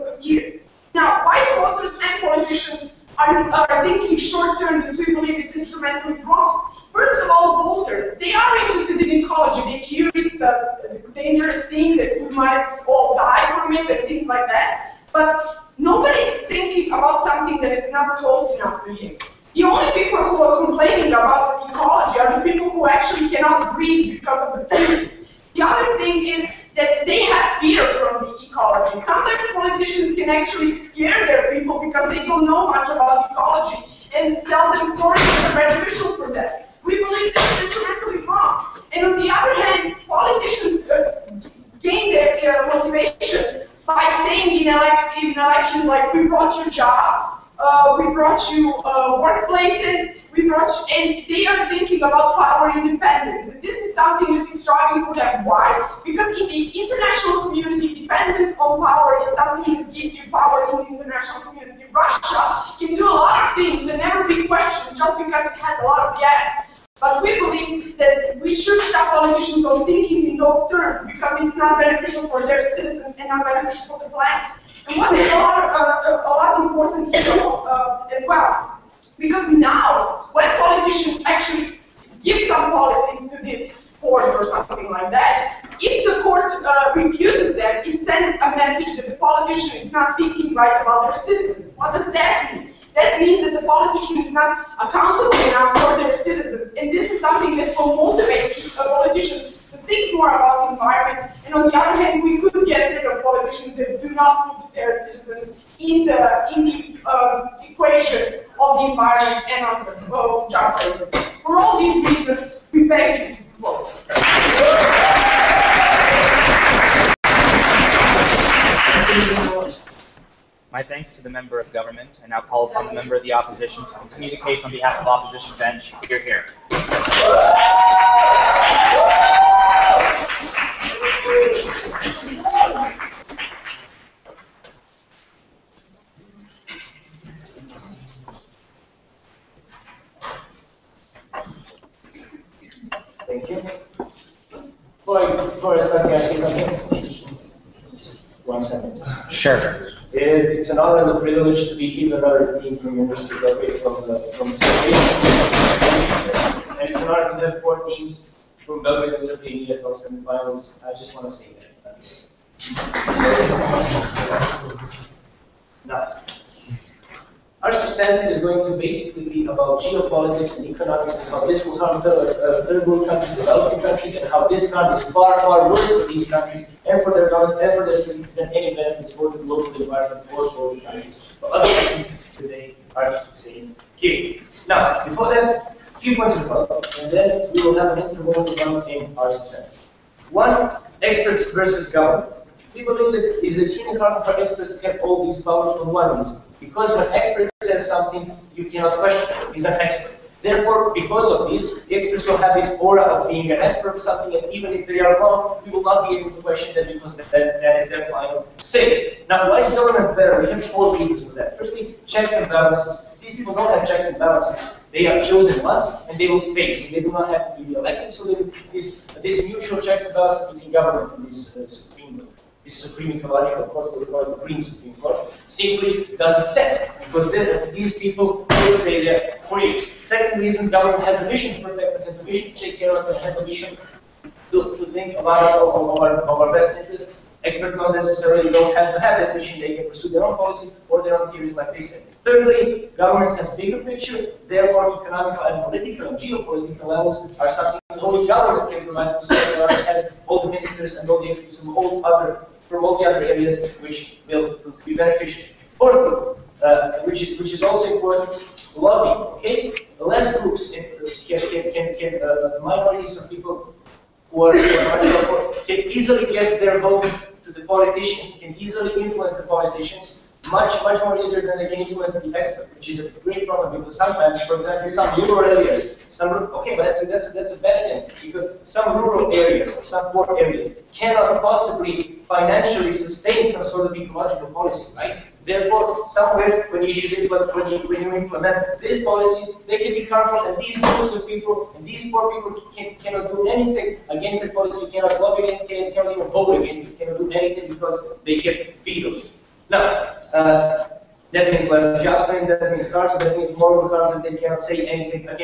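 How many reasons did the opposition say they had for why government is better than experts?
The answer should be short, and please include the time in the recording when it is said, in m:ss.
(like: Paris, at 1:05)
4, at 3:30.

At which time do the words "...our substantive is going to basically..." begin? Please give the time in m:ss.
2:47.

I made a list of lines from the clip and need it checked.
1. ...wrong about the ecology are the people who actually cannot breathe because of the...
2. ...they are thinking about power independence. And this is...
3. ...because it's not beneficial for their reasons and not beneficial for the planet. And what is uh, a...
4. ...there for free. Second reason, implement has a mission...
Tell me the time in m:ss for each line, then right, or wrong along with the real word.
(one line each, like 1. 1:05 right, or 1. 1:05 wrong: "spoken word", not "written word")
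1. 0:20 wrong: "complaining", not "wrong"
2. 0:51 right
3. 1:11 wrong: "citizens", not "reasons"
4. 3:48 wrong: "government", not "implement".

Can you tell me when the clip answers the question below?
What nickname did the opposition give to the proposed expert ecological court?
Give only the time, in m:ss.
3:44.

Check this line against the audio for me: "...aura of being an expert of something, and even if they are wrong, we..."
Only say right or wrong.
right.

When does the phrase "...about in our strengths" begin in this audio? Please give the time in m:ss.
3:08.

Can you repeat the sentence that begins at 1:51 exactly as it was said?
For all these reasons, we thank you both.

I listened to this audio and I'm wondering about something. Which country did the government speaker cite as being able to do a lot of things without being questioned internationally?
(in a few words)
Russia.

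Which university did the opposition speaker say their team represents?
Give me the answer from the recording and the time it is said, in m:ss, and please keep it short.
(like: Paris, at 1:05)
University of Belgrade, at 2:32.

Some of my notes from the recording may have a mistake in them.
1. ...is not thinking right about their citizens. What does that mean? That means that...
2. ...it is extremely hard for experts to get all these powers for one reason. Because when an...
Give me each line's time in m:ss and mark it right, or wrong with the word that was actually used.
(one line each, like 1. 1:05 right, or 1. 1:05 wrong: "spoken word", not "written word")
1. 1:29 right
2. 3:13 right.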